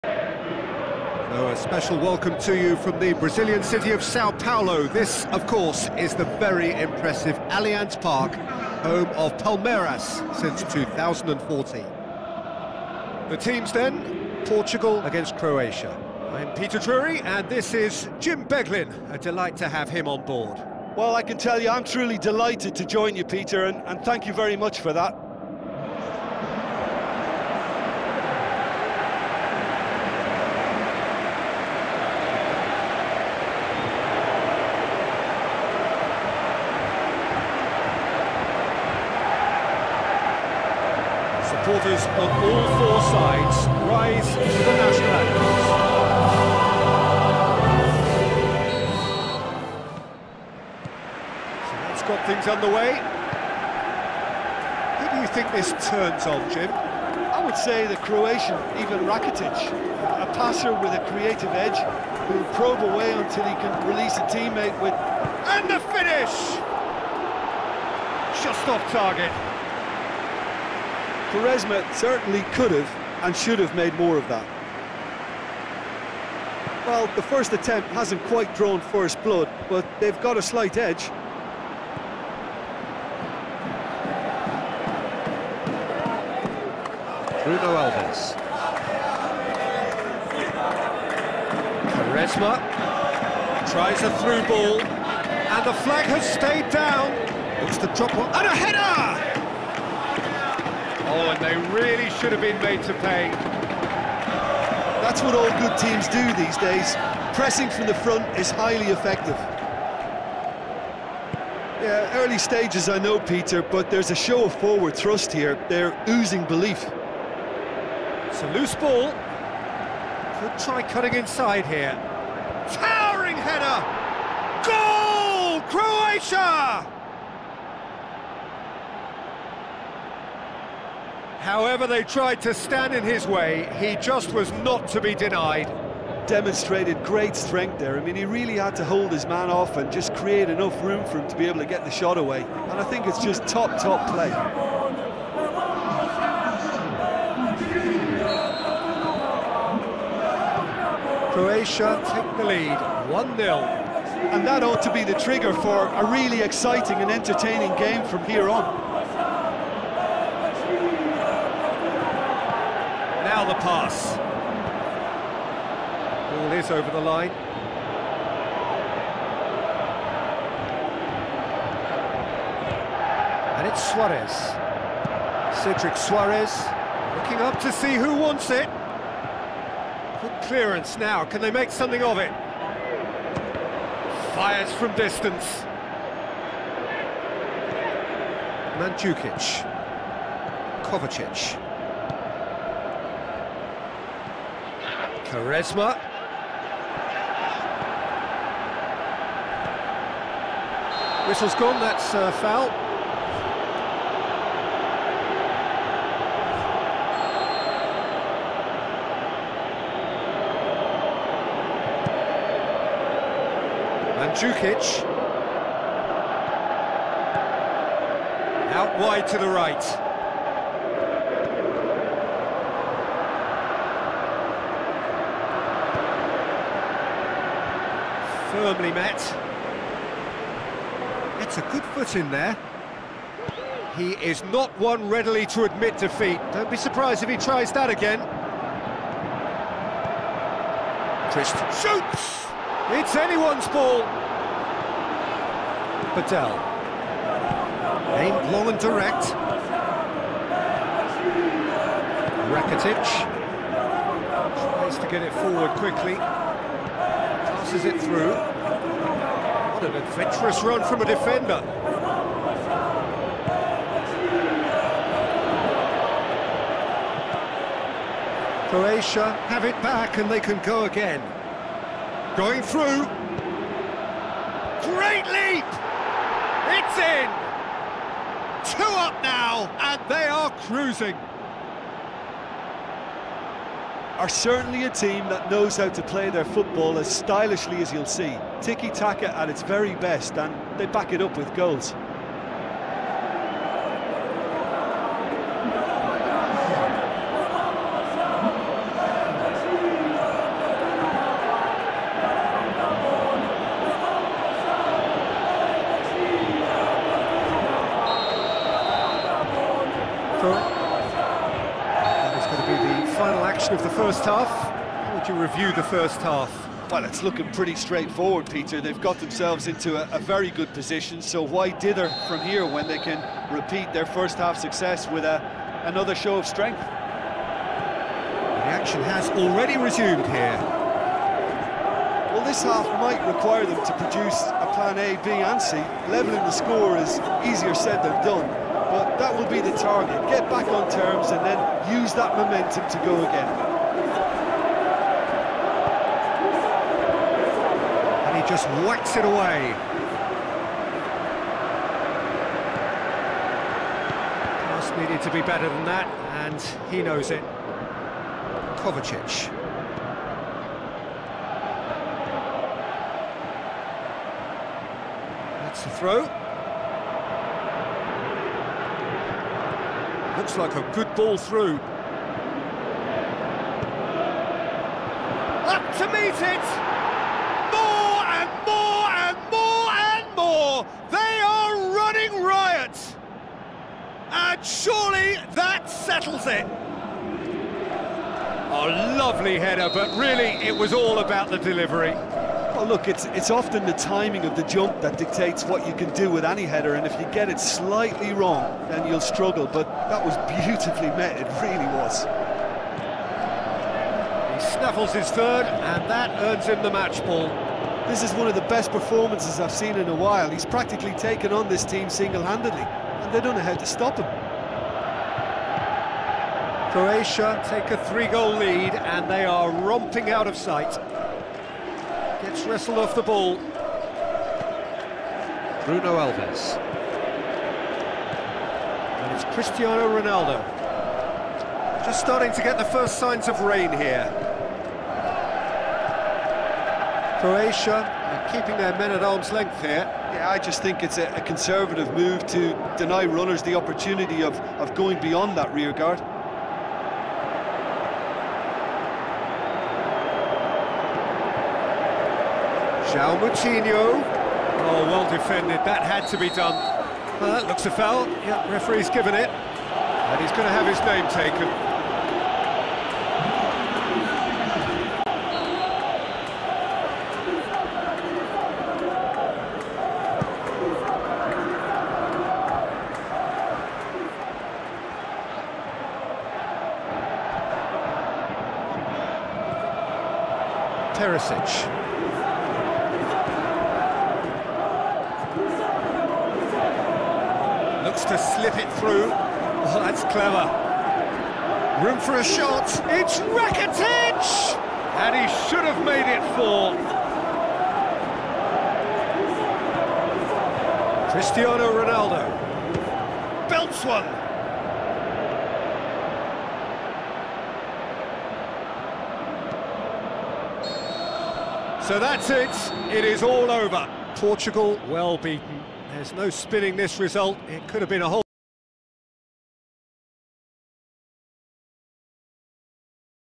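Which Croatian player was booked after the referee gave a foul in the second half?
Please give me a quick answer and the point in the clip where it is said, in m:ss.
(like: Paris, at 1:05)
Perisic, at 8:01.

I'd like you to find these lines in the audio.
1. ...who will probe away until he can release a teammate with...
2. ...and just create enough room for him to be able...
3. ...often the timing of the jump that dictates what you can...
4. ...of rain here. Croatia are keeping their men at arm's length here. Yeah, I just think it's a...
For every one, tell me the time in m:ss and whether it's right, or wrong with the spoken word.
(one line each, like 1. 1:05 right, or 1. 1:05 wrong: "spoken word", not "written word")
1. 1:02 right
2. 2:19 right
3. 6:33 right
4. 7:13 right.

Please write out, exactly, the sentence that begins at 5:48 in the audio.
And he just whacks it away.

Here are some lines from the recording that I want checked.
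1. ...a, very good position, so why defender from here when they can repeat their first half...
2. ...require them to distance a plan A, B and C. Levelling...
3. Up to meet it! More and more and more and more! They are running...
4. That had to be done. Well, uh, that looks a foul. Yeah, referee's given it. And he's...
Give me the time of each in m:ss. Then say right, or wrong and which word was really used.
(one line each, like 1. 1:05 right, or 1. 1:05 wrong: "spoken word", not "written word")
1. 5:20 wrong: "dither", not "defender"
2. 5:33 wrong: "produce", not "distance"
3. 6:15 right
4. 7:35 right.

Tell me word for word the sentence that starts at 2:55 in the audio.
Cedric Soares looking up to see who wants it.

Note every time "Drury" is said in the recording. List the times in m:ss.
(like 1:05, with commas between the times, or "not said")
0:16.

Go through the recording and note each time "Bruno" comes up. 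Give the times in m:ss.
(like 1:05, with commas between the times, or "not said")
1:27, 7:05.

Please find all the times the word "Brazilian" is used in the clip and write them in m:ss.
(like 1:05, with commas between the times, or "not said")
0:03.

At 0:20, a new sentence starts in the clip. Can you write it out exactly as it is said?
Well, I can tell you I'm truly delighted to join you, Peter, and, and thank you very much for that.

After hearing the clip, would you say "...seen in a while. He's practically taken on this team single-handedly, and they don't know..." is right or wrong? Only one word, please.
right.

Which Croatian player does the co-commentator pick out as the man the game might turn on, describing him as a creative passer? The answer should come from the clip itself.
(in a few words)
Ivan Rakitic.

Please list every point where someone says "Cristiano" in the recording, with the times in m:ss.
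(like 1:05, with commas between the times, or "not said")
7:09, 8:21.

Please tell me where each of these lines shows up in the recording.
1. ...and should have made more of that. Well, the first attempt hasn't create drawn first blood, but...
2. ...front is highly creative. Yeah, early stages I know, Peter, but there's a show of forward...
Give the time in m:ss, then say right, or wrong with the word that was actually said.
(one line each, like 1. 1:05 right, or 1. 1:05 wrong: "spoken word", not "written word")
1. 1:13 wrong: "quite", not "create"
2. 1:47 wrong: "effective", not "creative".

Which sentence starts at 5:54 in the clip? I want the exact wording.
Pass needed to be better than that, and he knows it.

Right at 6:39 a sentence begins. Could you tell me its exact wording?
But that was beautifully met, it really was.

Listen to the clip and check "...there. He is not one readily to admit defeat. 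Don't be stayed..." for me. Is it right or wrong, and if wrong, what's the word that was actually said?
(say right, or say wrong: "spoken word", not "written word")
wrong: "surprised", not "stayed".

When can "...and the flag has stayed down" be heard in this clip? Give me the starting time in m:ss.
1:34.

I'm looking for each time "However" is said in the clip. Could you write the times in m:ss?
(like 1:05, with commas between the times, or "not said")
2:11.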